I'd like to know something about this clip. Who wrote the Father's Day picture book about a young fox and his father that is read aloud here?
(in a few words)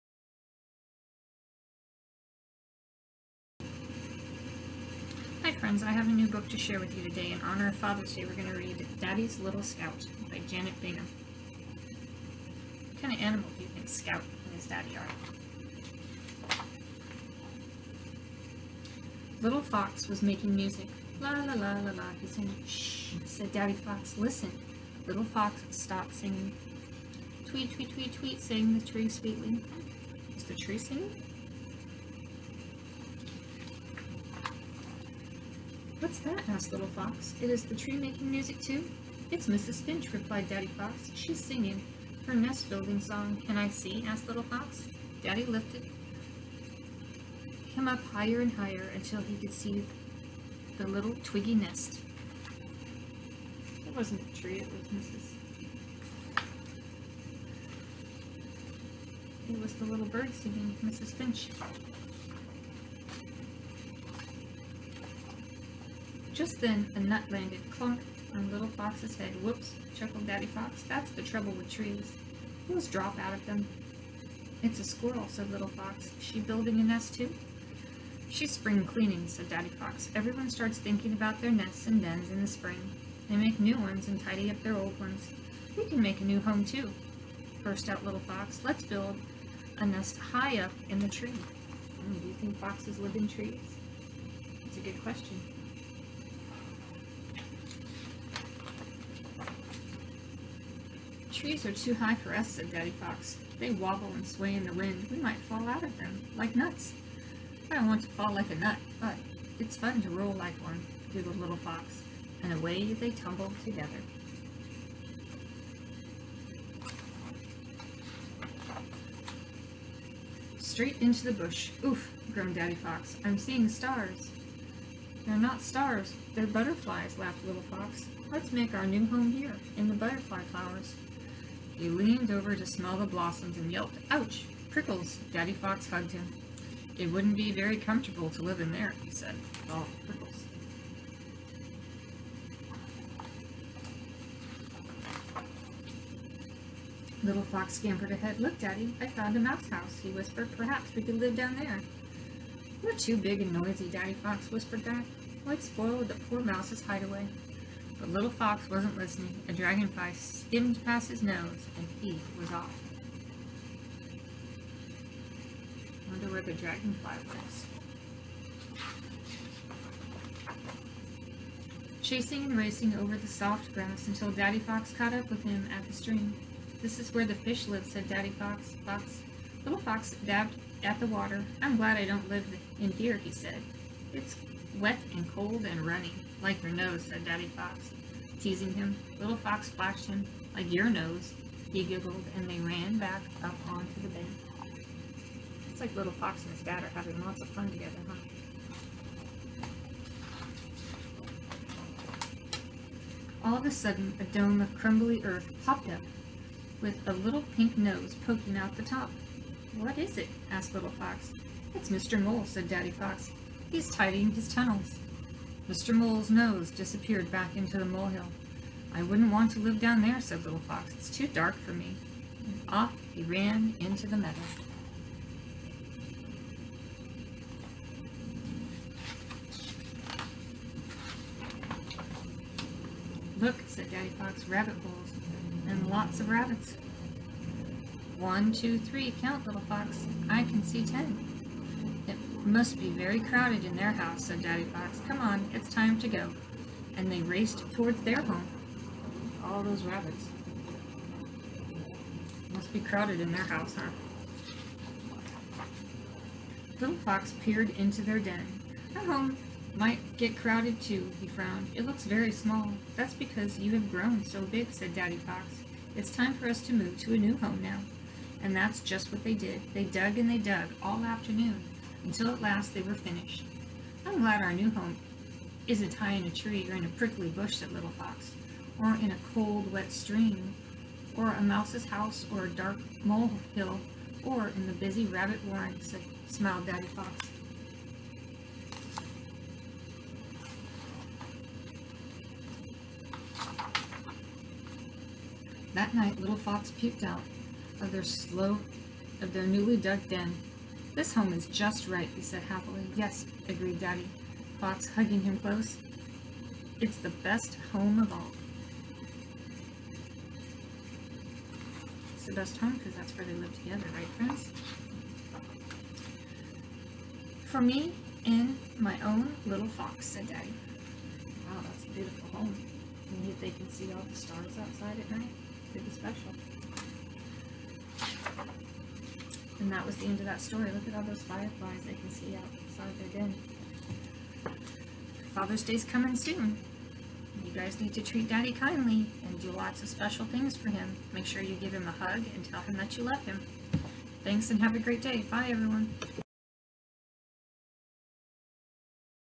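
Janet Bingham.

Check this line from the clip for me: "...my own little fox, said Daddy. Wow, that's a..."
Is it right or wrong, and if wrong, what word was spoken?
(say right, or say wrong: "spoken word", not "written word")
right.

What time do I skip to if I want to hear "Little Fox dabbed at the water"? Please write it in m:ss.
2:59.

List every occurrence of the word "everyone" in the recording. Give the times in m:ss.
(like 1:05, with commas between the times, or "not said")
1:20, 5:45.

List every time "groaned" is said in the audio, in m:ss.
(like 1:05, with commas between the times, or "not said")
2:02.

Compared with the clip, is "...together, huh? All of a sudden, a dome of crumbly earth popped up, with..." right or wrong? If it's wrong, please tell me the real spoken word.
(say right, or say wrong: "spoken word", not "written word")
right.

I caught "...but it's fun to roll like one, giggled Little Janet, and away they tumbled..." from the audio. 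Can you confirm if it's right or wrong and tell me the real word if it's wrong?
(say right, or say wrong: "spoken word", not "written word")
wrong: "Fox", not "Janet".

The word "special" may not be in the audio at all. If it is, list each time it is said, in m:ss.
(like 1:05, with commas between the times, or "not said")
5:25, 5:39.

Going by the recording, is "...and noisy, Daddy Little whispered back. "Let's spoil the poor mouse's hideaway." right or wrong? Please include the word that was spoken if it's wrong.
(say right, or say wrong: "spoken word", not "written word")
wrong: "Fox", not "Little".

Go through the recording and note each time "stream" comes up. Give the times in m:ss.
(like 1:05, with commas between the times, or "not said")
2:55, 4:39.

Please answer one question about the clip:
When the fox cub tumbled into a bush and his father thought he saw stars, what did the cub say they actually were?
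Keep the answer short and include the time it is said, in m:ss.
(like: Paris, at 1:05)
butterflies, at 2:06.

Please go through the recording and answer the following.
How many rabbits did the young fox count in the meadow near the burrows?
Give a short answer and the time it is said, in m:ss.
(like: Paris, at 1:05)
10, at 4:00.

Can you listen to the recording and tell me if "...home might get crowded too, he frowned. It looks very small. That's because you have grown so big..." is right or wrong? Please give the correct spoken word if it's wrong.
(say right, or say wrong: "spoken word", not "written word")
right.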